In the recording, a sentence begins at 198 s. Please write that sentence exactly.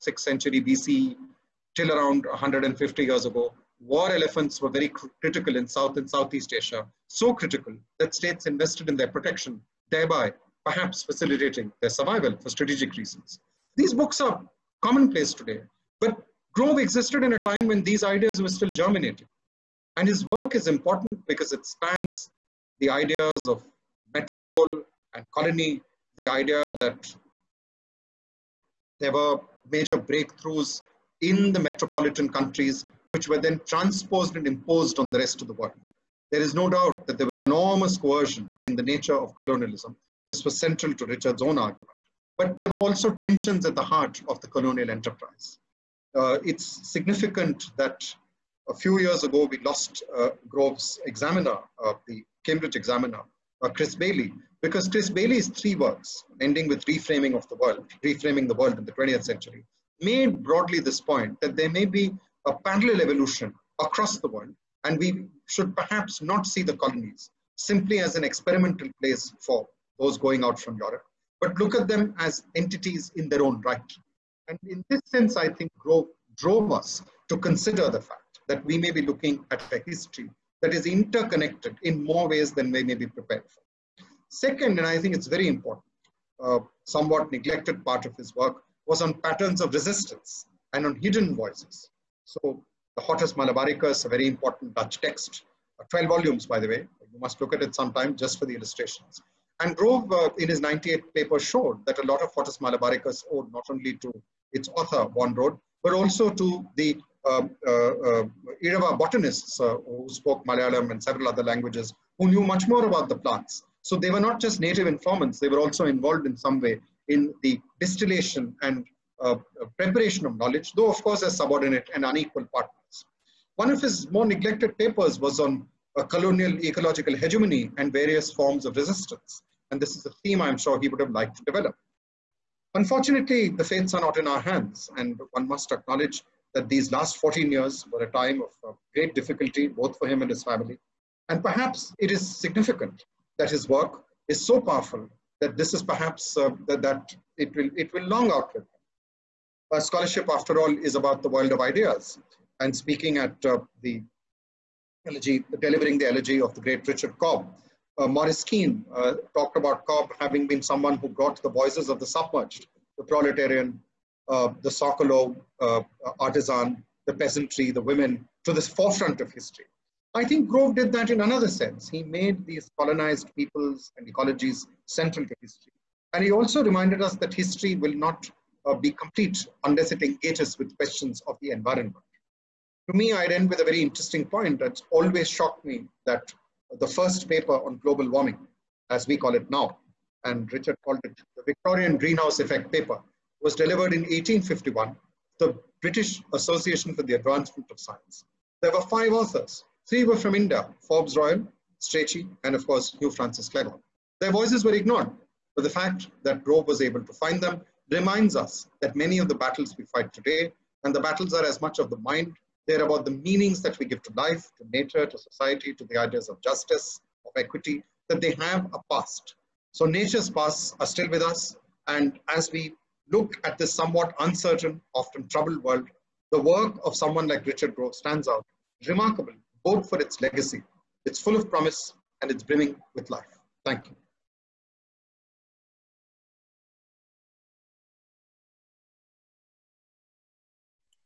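There were five authors, Three were from India, Forbes Royle, Strachey, and of course, Hugh Francis Cleghorn.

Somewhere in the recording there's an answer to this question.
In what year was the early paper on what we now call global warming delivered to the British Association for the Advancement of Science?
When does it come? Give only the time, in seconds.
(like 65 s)
193 s.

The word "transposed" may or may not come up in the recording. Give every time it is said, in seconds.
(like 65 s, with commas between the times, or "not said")
33 s.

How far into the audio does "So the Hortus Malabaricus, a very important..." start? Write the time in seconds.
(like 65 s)
92 s.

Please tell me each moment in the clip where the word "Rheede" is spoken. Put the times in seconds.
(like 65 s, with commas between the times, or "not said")
105 s.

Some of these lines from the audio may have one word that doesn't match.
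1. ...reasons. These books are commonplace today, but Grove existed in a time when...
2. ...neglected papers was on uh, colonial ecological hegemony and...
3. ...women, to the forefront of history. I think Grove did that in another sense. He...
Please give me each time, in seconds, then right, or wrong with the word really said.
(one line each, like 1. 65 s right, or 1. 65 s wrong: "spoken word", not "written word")
1. 12 s right
2. 124 s right
3. 167 s right.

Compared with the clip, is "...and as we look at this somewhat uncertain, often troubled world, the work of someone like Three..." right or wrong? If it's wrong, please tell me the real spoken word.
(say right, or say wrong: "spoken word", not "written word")
wrong: "Richard", not "Three".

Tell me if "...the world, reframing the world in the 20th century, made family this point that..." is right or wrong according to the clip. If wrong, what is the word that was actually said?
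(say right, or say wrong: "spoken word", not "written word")
wrong: "broadly", not "family".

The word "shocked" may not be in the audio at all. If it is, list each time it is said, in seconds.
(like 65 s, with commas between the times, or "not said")
185 s.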